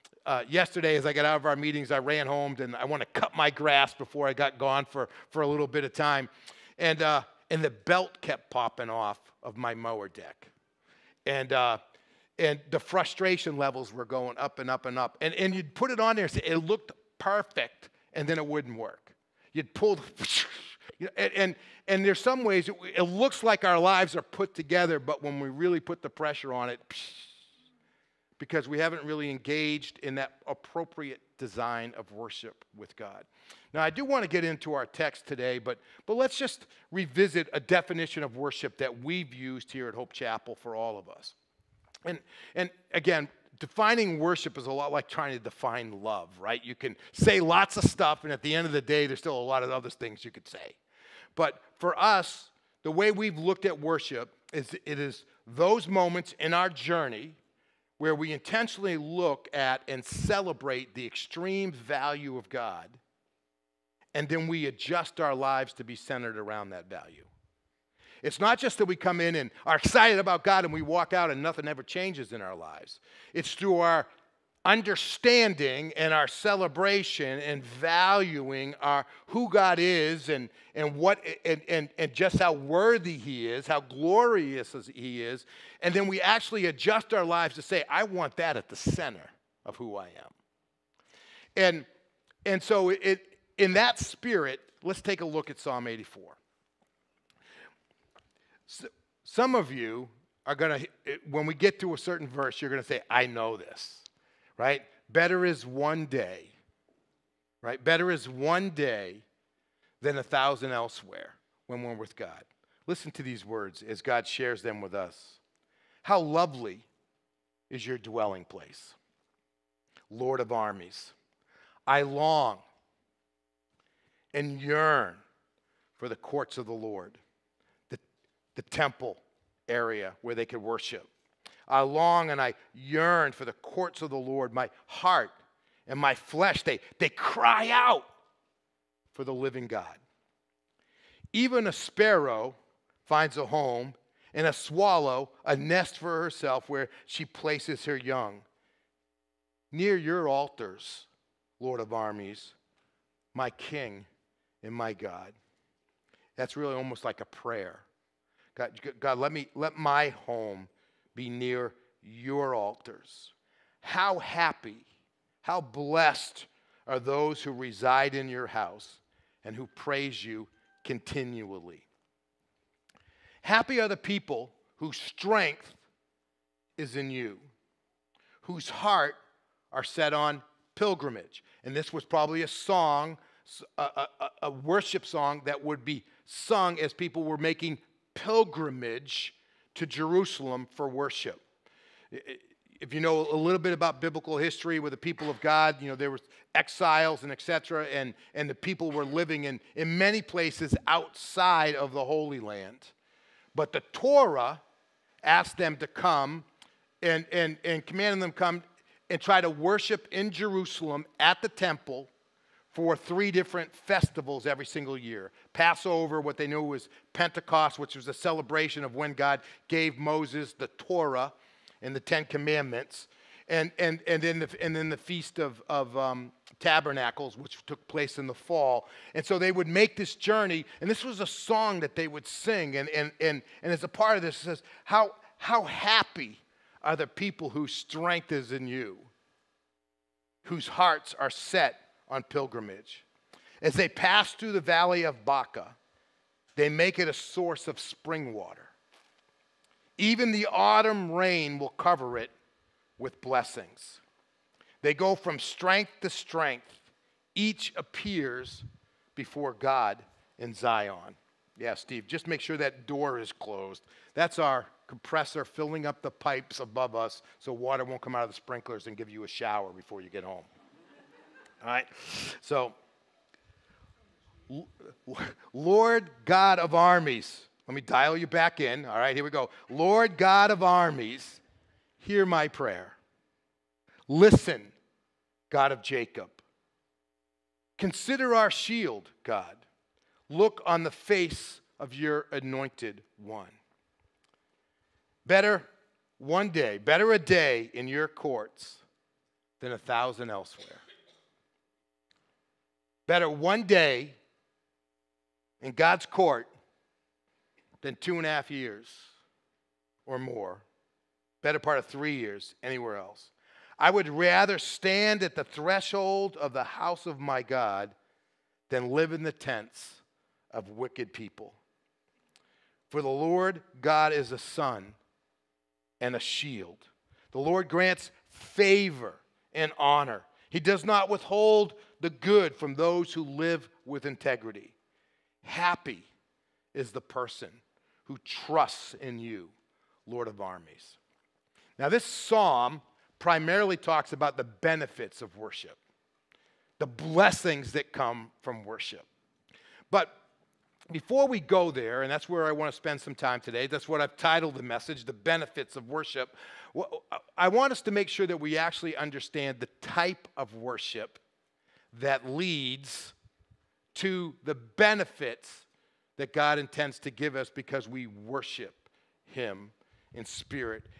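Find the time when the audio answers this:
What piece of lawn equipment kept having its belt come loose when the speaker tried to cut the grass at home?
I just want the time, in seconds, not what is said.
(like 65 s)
9 s.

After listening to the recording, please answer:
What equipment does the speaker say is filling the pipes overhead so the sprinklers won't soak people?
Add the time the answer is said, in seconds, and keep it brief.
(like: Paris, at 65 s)
compressor, at 264 s.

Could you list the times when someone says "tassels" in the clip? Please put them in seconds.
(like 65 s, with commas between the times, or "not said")
not said.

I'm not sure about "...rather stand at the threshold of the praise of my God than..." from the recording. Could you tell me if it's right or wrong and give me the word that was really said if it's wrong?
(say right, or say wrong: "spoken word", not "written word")
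wrong: "house", not "praise".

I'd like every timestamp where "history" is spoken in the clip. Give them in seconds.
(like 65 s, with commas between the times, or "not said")
194 s.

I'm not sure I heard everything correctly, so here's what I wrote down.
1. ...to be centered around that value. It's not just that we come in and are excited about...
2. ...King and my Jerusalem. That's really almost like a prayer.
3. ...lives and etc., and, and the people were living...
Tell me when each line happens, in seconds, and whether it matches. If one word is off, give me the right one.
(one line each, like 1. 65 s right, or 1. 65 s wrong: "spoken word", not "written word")
1. 65 s right
2. 153 s wrong: "God", not "Jerusalem"
3. 196 s wrong: "exiles", not "lives".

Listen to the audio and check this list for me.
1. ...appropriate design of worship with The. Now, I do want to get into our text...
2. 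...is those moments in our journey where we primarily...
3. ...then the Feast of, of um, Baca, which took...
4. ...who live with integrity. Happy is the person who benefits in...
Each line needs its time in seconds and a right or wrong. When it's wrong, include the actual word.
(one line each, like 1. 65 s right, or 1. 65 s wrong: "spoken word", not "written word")
1. 30 s wrong: "God", not "The"
2. 54 s wrong: "intentionally", not "primarily"
3. 224 s wrong: "Tabernacles", not "Baca"
4. 333 s wrong: "trusts", not "benefits".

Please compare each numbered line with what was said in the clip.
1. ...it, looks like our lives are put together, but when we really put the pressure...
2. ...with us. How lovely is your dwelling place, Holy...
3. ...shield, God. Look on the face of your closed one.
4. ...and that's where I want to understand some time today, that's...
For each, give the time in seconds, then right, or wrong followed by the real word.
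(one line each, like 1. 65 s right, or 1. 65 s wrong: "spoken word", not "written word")
1. 22 s right
2. 114 s wrong: "Lord", not "Holy"
3. 288 s wrong: "anointed", not "closed"
4. 352 s wrong: "spend", not "understand".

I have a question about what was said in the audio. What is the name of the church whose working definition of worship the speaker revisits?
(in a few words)
Hope Chapel.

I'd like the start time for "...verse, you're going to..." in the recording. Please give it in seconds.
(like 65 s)
102 s.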